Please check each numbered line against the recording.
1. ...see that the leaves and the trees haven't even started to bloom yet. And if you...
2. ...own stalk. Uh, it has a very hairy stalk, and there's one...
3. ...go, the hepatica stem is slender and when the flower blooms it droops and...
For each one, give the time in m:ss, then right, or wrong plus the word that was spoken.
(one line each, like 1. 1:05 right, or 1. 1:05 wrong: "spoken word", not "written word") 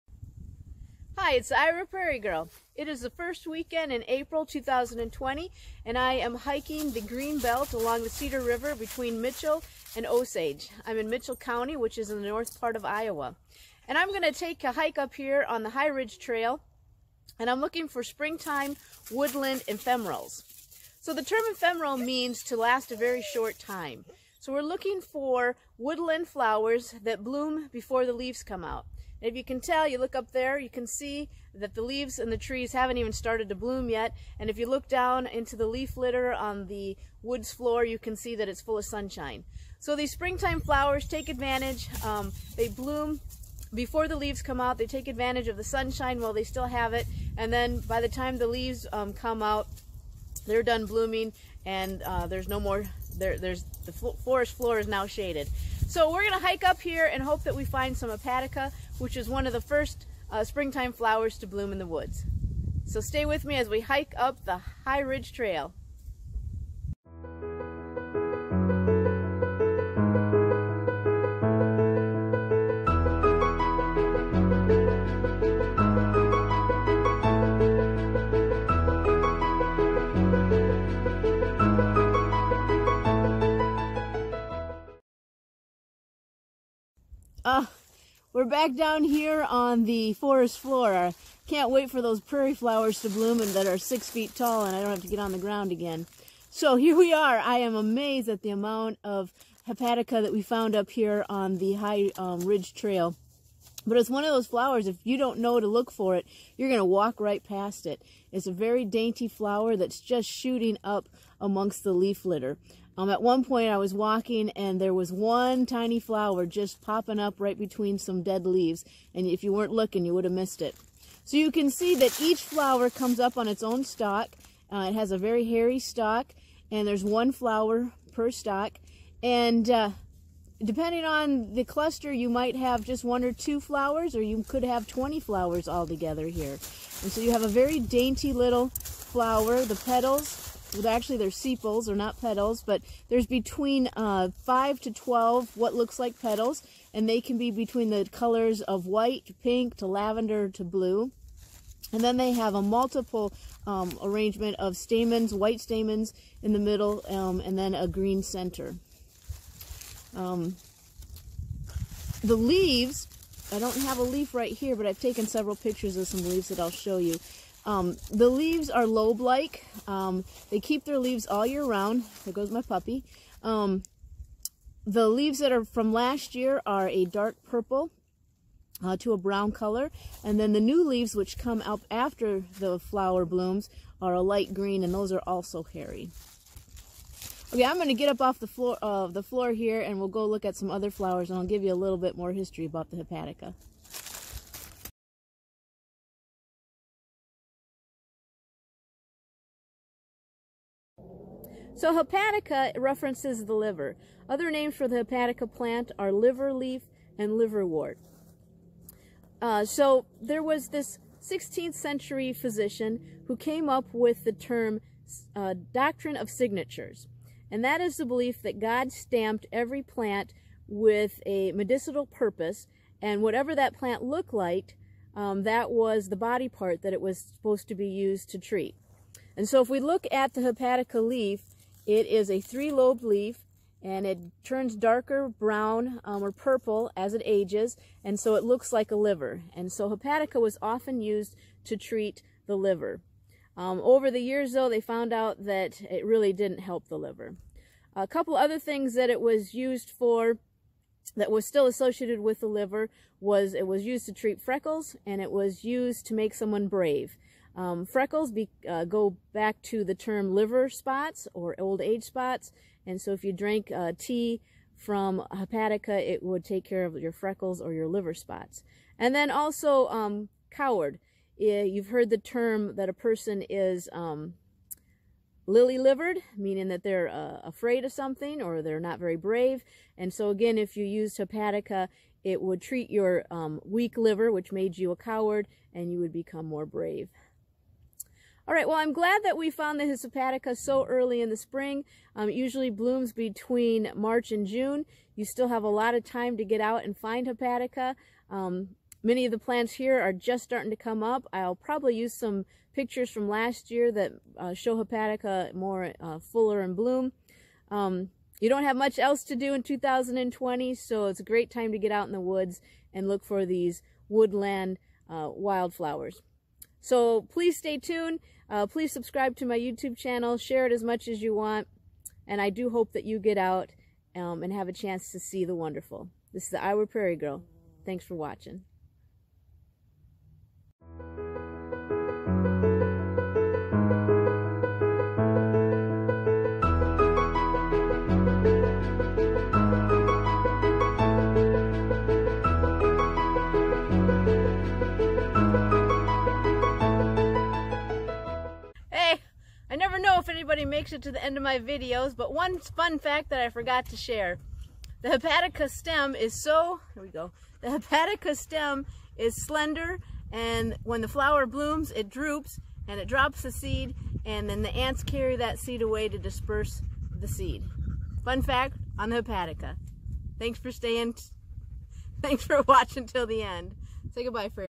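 1. 0:30 right
2. 2:03 right
3. 5:57 right.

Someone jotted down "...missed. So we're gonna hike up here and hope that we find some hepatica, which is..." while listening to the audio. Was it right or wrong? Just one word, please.
wrong.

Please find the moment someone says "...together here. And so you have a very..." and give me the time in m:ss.
2:15.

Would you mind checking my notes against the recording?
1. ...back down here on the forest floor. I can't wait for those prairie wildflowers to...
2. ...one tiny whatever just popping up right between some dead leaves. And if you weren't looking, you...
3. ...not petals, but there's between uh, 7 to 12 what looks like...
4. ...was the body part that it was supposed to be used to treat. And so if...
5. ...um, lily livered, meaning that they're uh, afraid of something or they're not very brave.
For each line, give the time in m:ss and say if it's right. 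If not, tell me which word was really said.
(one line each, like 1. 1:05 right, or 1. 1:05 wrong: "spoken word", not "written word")
1. 1:28 wrong: "flowers", not "wildflowers"
2. 1:55 wrong: "flower", not "whatever"
3. 2:21 wrong: "5", not "7"
4. 3:45 right
5. 4:33 right.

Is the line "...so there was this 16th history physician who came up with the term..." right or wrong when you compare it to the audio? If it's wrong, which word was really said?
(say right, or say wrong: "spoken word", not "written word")
wrong: "century", not "history".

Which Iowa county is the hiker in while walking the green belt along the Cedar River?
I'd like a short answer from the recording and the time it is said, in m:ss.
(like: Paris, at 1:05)
Mitchell County, at 0:11.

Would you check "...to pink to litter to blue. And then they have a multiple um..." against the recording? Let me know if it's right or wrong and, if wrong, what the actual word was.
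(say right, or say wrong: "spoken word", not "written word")
wrong: "lavender", not "litter".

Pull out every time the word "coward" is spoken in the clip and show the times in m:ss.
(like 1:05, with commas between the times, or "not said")
4:30, 4:44.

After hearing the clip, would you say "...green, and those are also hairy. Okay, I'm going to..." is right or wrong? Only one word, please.
right.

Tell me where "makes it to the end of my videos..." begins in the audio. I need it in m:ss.
5:50.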